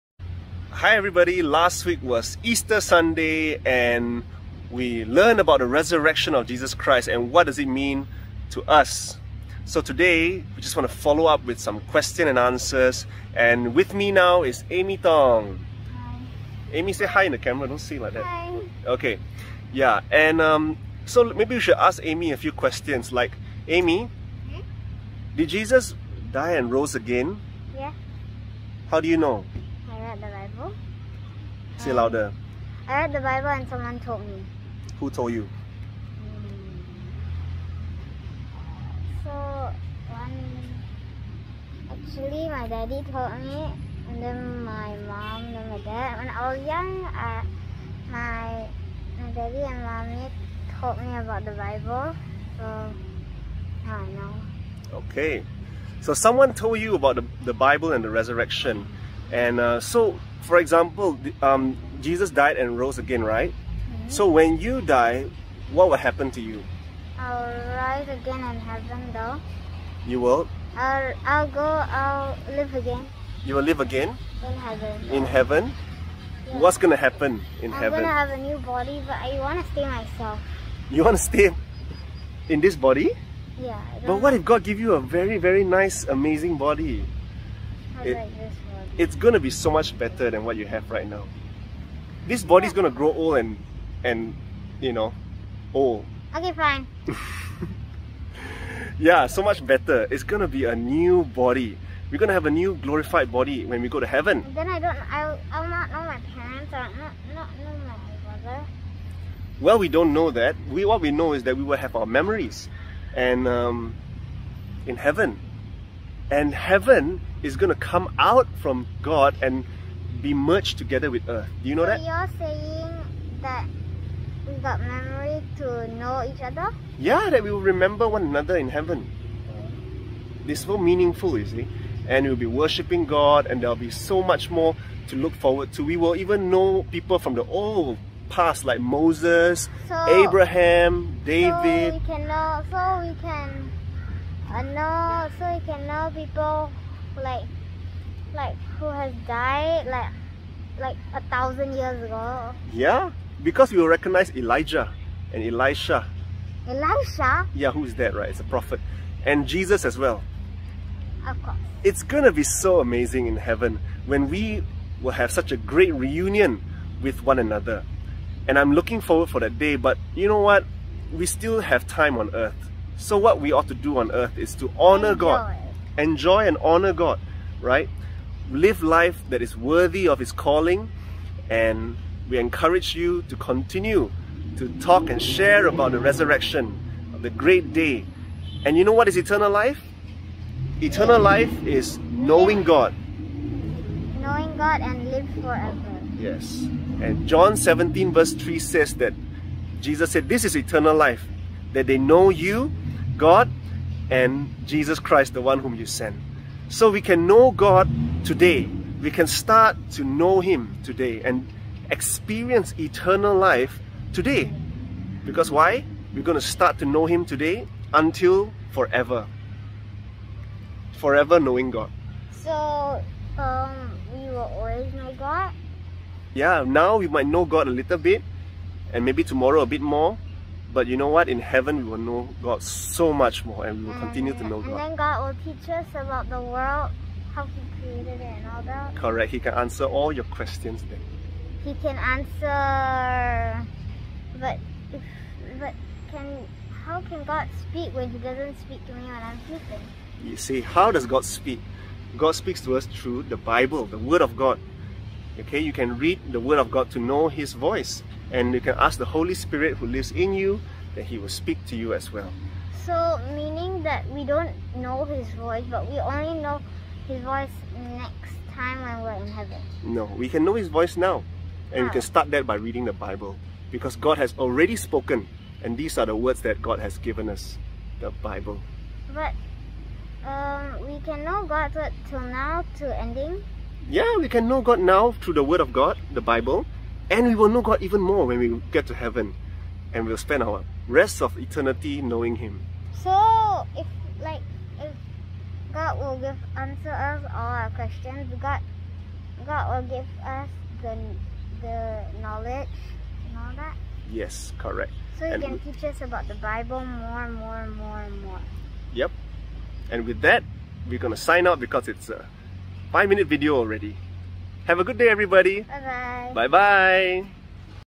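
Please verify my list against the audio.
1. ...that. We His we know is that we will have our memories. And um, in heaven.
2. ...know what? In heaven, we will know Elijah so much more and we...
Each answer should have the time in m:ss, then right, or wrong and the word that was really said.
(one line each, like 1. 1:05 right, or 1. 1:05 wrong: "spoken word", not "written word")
1. 1:50 wrong: "What", not "His"
2. 3:50 wrong: "God", not "Elijah".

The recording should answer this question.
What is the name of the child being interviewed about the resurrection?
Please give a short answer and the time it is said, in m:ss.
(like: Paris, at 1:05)
Amie Tong, at 0:14.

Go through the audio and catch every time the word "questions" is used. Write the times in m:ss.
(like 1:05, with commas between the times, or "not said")
0:11, 0:22, 4:00, 4:57.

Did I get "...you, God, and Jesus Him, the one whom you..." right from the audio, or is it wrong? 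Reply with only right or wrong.
wrong.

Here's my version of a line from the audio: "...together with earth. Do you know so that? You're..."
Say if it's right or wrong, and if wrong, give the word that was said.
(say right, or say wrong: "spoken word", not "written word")
right.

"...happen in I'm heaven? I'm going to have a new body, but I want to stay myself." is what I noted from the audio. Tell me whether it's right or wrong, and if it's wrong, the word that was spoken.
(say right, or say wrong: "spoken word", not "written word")
right.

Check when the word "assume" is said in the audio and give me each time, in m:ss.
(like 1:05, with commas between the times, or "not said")
not said.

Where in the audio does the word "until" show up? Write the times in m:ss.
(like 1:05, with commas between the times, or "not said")
3:37.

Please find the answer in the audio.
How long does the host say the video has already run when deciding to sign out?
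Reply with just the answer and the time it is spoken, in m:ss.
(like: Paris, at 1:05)
5 minutes, at 5:12.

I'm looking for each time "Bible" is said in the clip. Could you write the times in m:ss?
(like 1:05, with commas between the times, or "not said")
0:33, 0:51, 0:57, 4:13, 4:32, 4:38, 4:46, 5:06.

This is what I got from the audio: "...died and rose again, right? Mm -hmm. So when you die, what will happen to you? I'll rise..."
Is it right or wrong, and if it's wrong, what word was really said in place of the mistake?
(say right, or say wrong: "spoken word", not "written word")
right.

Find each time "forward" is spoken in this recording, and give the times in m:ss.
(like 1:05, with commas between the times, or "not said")
2:15, 2:49.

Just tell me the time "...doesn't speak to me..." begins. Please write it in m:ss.
4:08.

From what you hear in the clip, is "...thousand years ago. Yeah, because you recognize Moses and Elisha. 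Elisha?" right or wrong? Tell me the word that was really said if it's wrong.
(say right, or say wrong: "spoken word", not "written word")
wrong: "Elijah", not "Moses".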